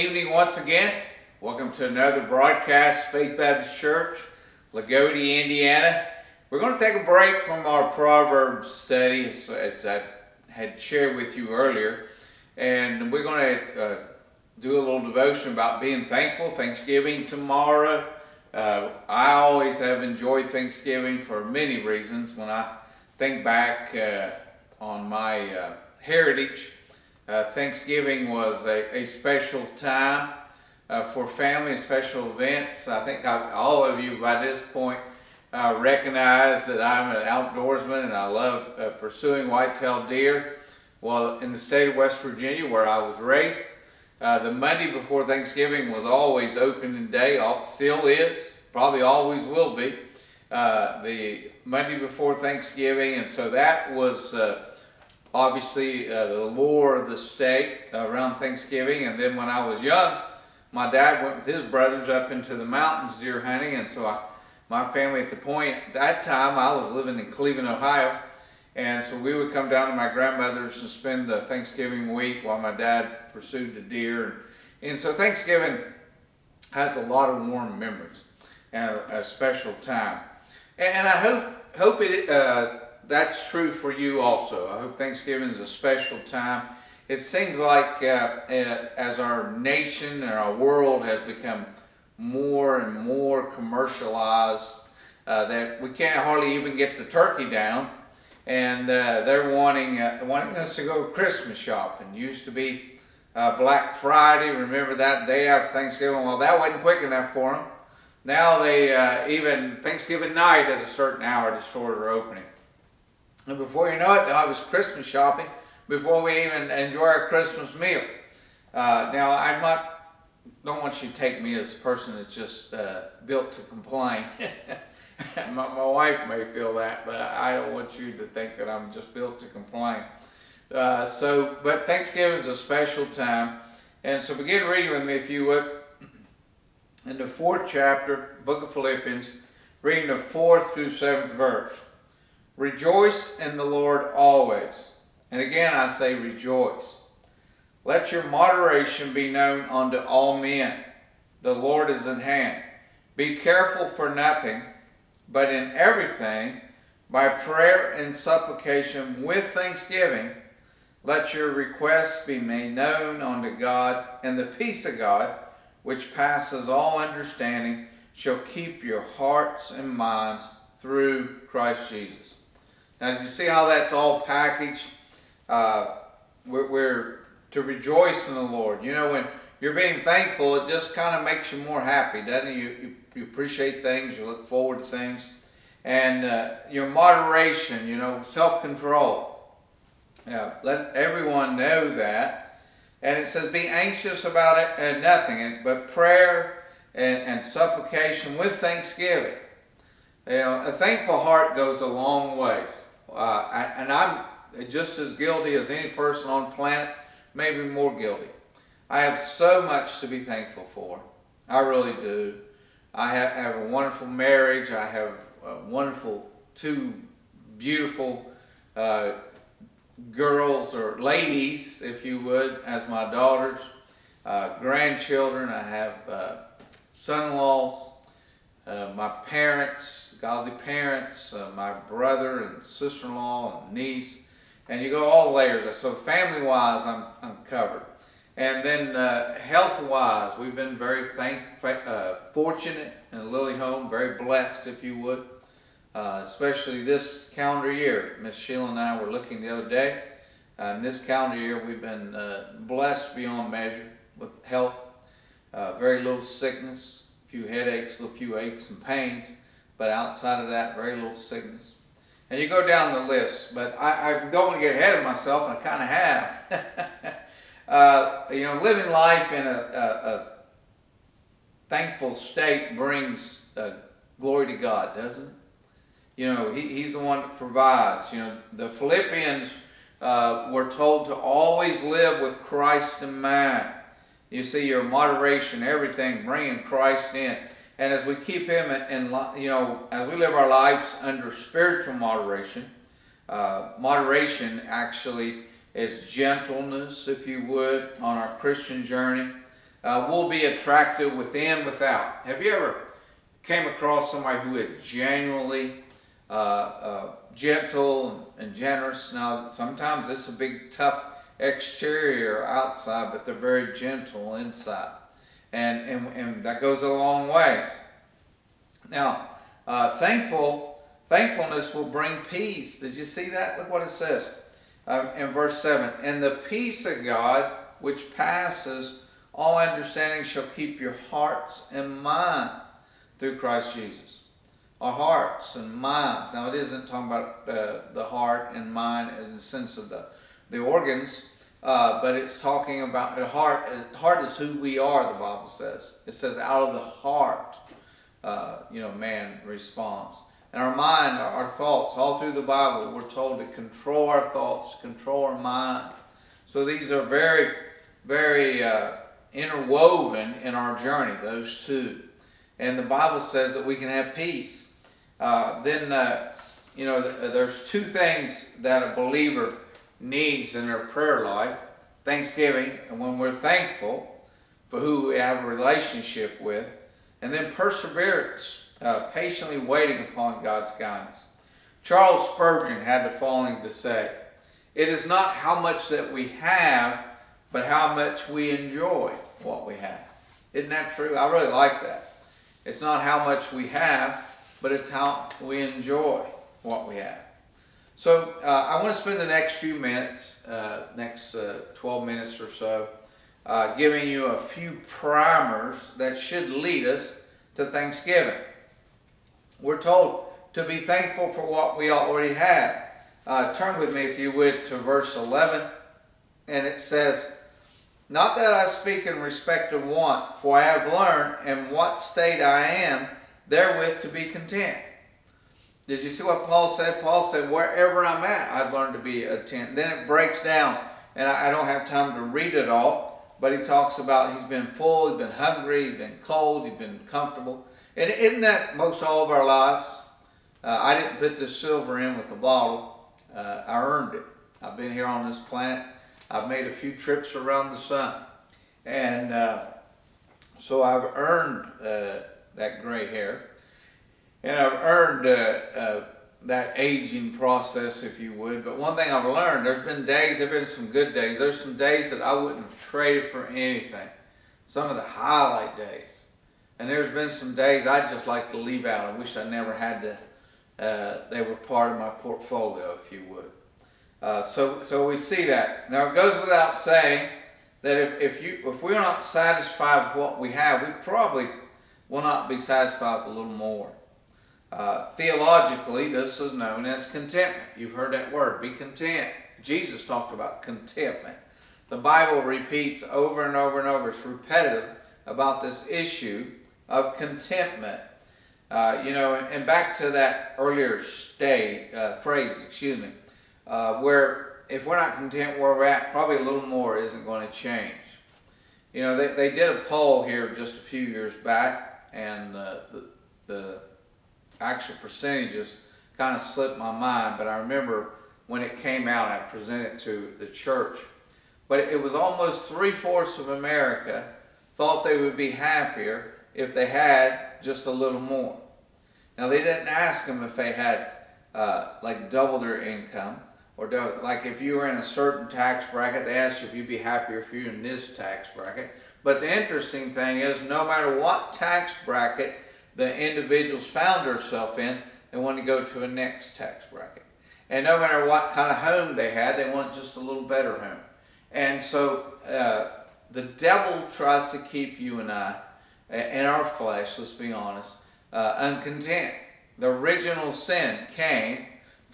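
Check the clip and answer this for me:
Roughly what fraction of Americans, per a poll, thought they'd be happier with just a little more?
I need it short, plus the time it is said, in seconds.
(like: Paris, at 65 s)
three-fourths, at 522 s.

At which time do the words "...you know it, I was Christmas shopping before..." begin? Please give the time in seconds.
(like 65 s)
113 s.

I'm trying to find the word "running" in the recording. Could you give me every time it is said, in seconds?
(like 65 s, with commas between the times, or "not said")
not said.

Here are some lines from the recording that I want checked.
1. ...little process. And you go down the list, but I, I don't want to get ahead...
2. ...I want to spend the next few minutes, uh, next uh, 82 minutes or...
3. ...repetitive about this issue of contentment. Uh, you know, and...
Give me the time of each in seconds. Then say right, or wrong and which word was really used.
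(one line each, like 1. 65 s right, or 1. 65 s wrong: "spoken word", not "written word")
1. 260 s wrong: "sickness", not "process"
2. 398 s wrong: "12", not "82"
3. 494 s right.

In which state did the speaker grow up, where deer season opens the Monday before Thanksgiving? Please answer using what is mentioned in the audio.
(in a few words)
West Virginia.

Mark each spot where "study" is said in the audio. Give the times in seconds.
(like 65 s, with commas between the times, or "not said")
8 s.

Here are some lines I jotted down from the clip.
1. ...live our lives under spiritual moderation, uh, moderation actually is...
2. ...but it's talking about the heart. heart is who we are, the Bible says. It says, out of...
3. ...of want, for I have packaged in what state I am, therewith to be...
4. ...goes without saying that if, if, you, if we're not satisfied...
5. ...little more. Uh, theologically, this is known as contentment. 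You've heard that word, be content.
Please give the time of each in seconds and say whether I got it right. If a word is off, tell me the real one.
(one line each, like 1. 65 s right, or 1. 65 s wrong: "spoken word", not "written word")
1. 290 s right
2. 342 s right
3. 419 s wrong: "learned", not "packaged"
4. 476 s right
5. 483 s right.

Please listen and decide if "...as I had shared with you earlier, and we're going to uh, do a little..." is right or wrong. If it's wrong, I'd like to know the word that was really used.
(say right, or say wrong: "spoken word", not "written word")
right.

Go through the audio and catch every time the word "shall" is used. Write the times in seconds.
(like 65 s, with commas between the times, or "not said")
168 s, 330 s.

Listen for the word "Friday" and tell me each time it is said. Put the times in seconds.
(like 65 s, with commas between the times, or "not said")
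103 s.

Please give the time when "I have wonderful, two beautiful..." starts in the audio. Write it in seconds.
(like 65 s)
214 s.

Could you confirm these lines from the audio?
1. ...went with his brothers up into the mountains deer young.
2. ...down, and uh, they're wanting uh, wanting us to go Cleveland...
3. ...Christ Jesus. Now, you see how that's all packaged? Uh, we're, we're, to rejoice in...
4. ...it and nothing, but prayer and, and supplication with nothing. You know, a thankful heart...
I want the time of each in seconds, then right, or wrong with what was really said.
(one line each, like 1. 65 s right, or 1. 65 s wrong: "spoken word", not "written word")
1. 61 s wrong: "hunting", not "young"
2. 97 s wrong: "Christmas", not "Cleveland"
3. 171 s right
4. 194 s wrong: "thanksgiving", not "nothing".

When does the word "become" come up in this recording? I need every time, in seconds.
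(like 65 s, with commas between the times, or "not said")
91 s.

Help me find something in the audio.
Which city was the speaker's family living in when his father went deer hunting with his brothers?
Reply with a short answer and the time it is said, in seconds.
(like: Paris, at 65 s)
Cleveland, Ohio, at 67 s.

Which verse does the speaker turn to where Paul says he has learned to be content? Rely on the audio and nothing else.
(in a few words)
verse 11.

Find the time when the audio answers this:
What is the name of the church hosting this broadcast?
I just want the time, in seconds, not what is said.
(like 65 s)
3 s.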